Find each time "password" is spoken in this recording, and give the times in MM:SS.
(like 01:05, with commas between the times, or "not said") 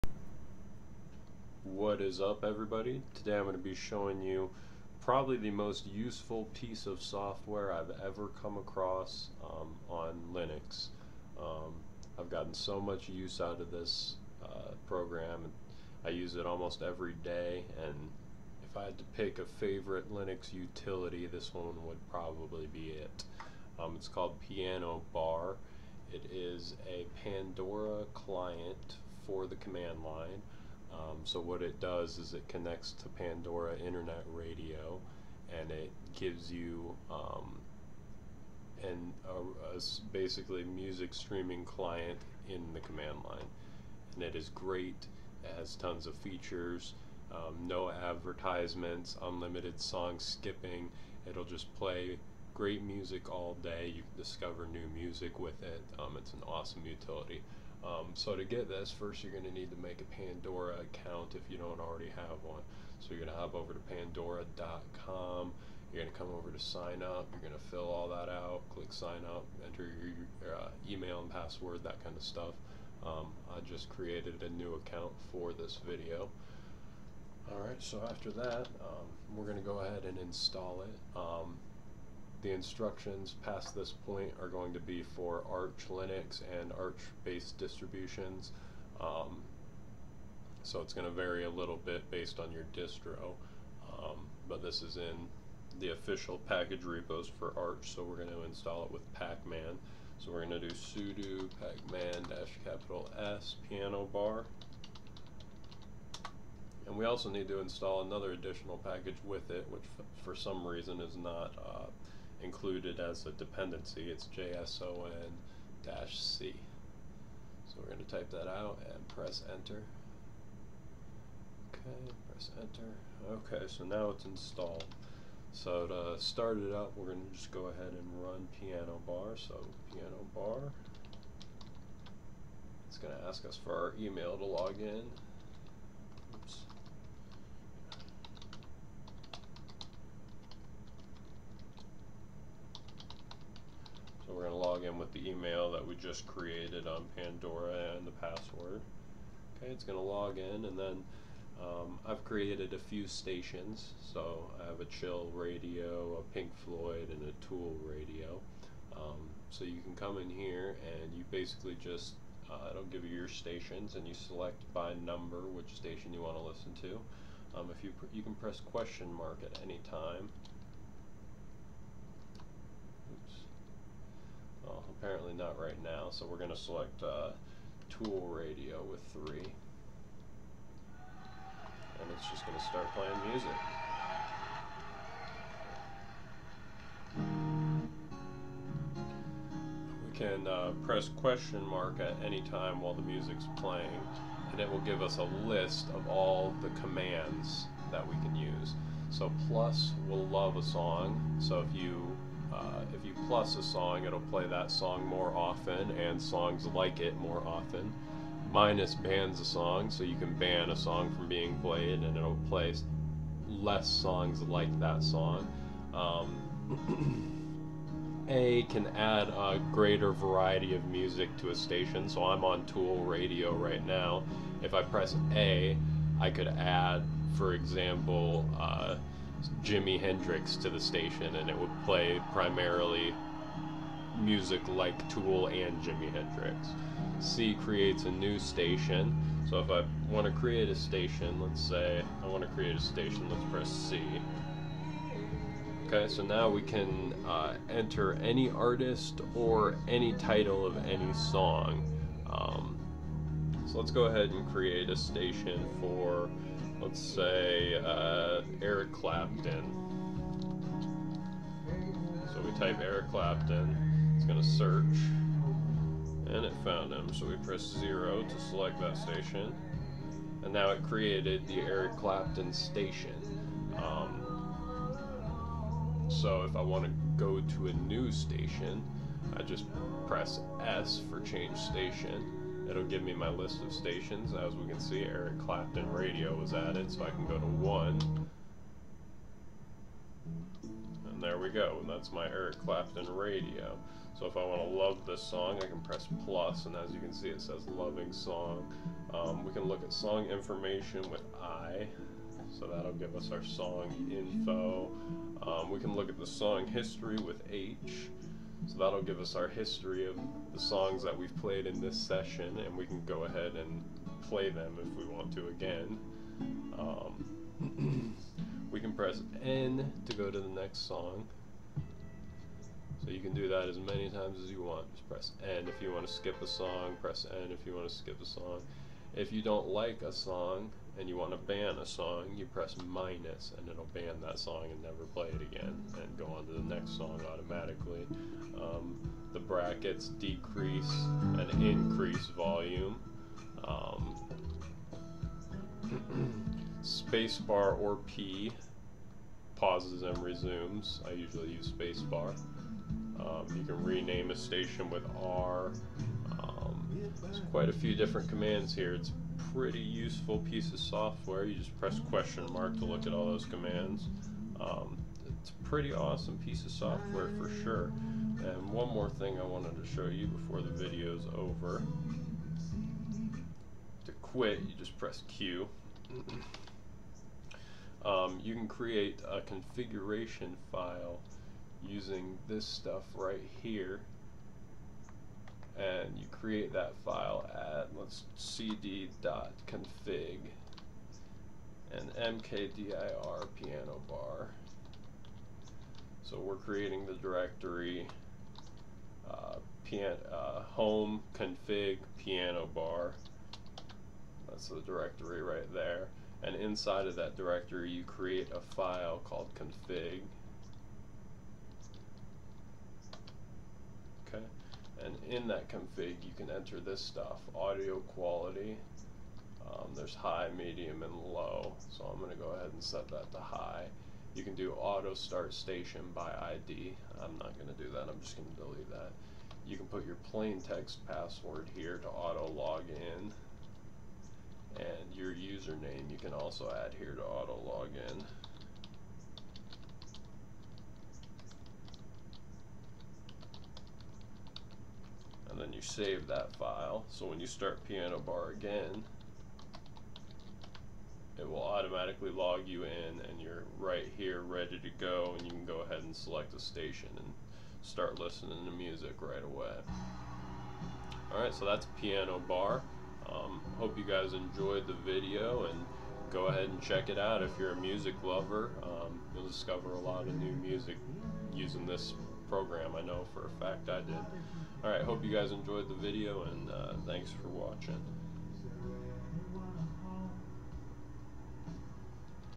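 01:11, 02:28, 07:11.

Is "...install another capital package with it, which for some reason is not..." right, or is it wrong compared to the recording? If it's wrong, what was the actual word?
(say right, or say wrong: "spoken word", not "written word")
wrong: "additional", not "capital".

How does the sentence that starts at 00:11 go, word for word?
Um, I've gotten so much use out of this uh, program.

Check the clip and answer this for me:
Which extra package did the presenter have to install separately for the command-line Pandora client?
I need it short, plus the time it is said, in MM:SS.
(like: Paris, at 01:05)
JSON-C, at 01:54.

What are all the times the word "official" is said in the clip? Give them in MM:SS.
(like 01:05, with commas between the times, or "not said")
01:35.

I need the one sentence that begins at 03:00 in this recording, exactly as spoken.
And it's just going to start playing music.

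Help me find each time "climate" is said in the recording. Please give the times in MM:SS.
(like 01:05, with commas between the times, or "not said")
not said.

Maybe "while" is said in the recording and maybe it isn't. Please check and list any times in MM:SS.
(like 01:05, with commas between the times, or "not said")
03:12.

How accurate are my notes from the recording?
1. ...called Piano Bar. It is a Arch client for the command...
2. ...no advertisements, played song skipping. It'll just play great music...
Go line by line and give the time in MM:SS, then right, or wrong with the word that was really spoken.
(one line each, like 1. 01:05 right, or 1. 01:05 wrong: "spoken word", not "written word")
1. 00:24 wrong: "Pandora", not "Arch"
2. 00:47 wrong: "unlimited", not "played".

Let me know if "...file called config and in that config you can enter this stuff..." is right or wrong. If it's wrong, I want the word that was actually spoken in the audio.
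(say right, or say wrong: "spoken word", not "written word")
right.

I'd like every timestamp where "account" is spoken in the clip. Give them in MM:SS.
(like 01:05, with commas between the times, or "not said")
01:00, 01:14.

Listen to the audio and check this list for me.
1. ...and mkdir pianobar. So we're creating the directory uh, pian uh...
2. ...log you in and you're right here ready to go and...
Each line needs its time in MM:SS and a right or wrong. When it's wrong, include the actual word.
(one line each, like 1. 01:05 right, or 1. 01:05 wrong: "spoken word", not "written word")
1. 06:31 right
2. 07:32 right.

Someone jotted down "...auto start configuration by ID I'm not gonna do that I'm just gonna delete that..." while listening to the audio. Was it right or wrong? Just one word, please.
wrong.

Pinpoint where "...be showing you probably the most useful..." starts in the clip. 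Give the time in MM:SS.
00:03.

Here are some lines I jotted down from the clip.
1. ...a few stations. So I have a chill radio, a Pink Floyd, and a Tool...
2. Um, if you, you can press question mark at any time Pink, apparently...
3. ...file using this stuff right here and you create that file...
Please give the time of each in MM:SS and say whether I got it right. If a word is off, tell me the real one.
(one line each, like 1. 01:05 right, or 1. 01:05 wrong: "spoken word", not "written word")
1. 02:32 right
2. 02:47 wrong: "Well", not "Pink"
3. 06:20 right.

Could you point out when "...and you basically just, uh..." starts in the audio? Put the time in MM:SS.
02:41.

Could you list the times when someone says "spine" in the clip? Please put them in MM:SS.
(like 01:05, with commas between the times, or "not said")
not said.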